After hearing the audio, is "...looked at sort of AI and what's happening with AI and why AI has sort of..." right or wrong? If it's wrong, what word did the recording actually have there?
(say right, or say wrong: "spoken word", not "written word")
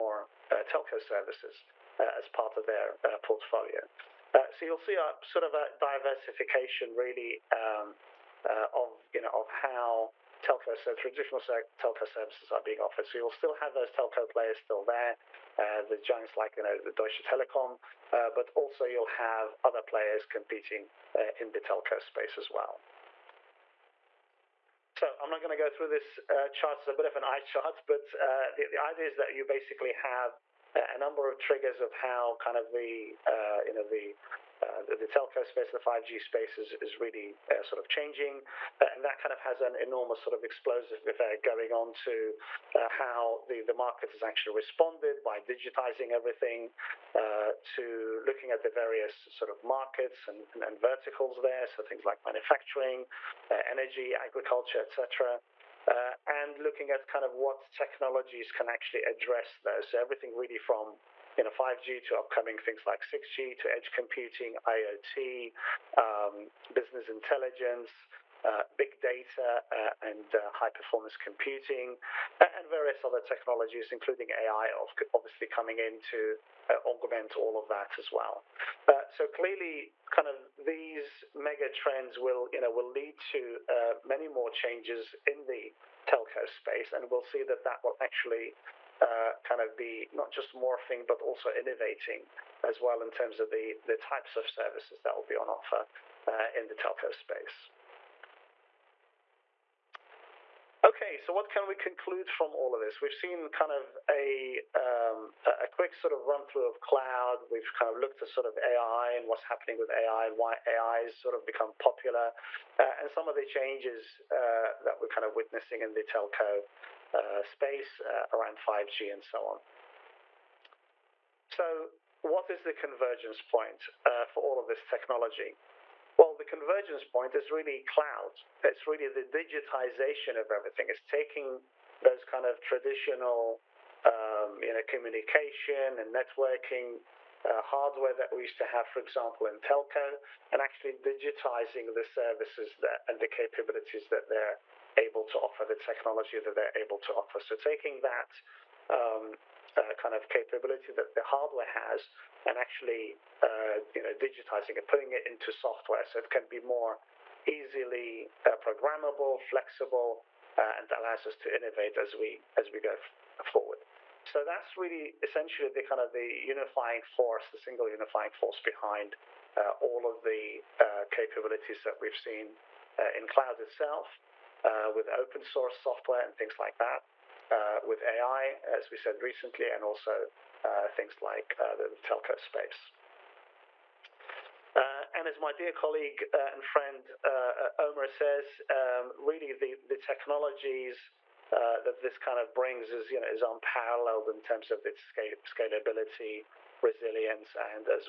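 right.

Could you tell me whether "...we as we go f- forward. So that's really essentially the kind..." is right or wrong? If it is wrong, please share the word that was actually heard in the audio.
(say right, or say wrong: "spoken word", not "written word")
right.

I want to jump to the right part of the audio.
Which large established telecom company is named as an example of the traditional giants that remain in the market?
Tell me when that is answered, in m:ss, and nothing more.
0:16.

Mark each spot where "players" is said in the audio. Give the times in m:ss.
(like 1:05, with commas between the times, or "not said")
0:14, 0:19.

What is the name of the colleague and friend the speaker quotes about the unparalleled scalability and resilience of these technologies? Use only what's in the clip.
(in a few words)
Omar.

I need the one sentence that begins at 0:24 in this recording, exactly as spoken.
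So I'm not going to go through this uh, chart.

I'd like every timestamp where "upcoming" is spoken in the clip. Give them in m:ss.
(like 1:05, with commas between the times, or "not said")
1:02.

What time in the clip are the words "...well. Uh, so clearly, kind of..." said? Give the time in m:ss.
1:18.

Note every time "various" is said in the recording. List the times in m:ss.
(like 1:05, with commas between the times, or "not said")
0:48, 1:12.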